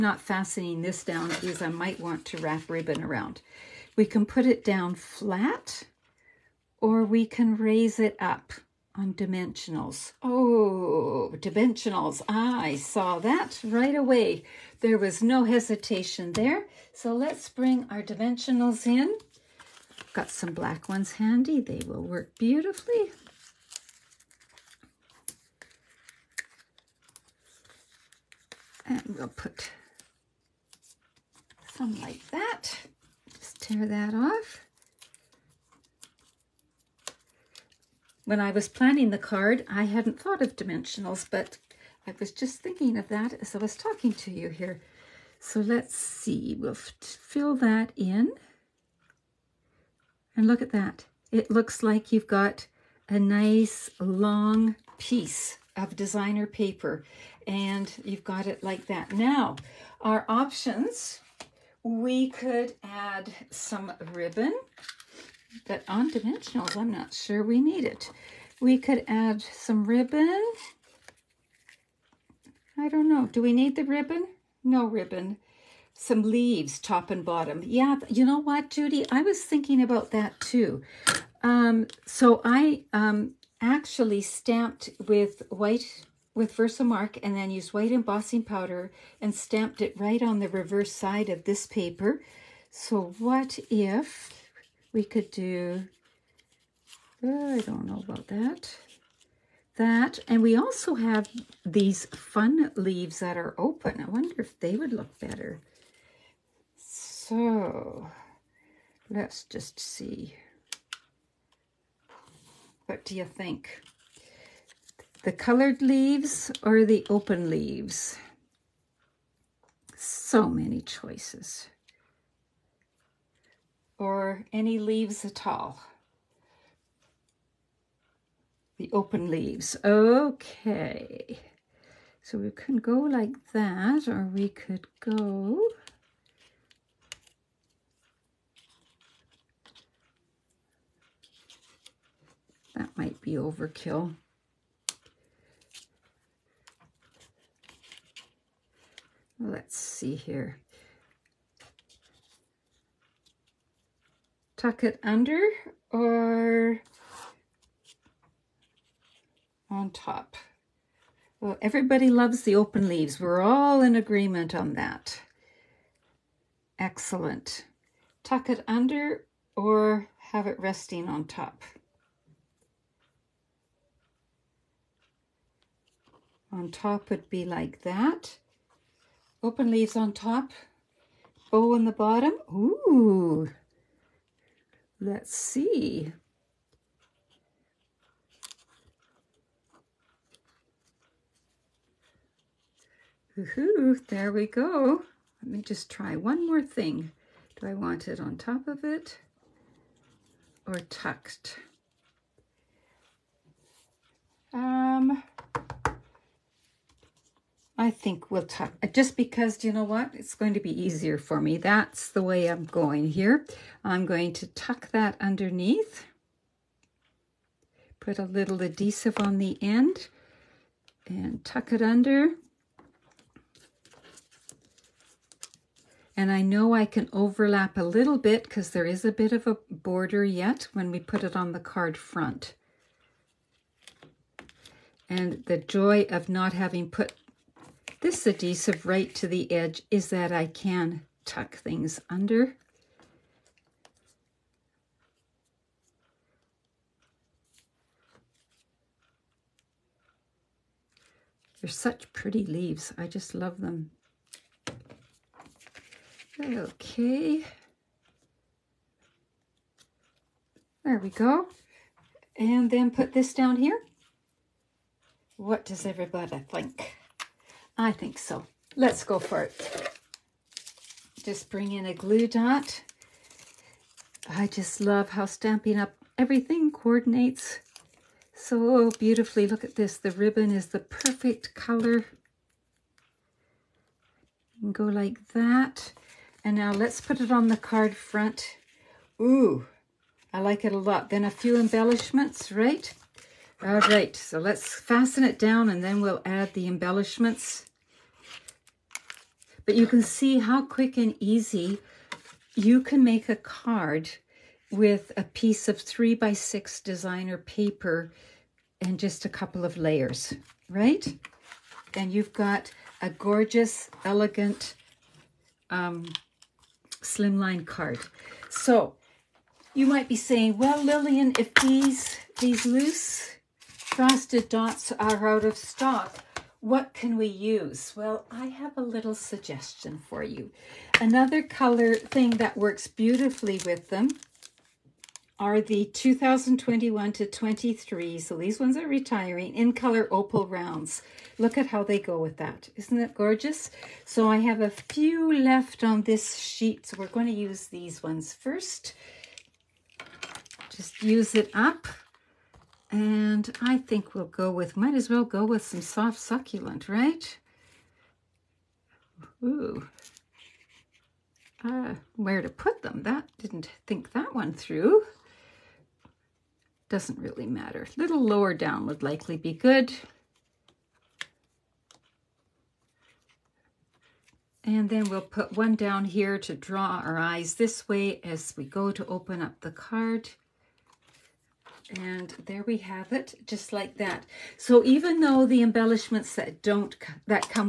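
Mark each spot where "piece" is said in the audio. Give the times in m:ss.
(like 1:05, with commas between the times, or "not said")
0:54, 5:05.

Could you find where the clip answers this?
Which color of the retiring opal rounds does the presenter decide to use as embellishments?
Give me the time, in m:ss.
5:55.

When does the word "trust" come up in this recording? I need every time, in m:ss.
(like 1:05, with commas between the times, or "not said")
not said.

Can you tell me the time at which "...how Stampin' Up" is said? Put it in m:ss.
4:35.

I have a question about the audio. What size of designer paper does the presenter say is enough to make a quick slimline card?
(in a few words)
3 by 6.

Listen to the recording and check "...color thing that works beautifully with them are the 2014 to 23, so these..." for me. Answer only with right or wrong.
wrong.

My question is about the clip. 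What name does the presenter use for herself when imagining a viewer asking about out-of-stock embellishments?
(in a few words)
Lillian.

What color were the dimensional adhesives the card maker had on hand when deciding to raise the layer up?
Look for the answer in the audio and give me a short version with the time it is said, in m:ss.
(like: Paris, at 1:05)
Black, at 0:20.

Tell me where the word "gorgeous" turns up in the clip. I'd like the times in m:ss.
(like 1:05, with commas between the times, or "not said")
5:13, 5:43.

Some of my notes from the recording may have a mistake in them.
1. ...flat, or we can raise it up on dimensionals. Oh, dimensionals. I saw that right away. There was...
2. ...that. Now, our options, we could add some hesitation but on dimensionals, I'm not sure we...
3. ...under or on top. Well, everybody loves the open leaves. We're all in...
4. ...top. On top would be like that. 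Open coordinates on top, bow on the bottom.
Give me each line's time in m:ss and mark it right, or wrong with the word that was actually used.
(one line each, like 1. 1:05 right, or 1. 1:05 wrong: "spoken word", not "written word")
1. 0:04 right
2. 0:58 wrong: "ribbon", not "hesitation"
3. 2:35 right
4. 2:51 wrong: "leaves", not "coordinates".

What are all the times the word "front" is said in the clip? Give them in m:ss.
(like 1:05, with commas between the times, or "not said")
3:51, 4:47.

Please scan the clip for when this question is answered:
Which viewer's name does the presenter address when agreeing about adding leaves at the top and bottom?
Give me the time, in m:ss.
1:18.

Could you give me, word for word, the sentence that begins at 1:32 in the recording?
So what if we could do, I don't know about that.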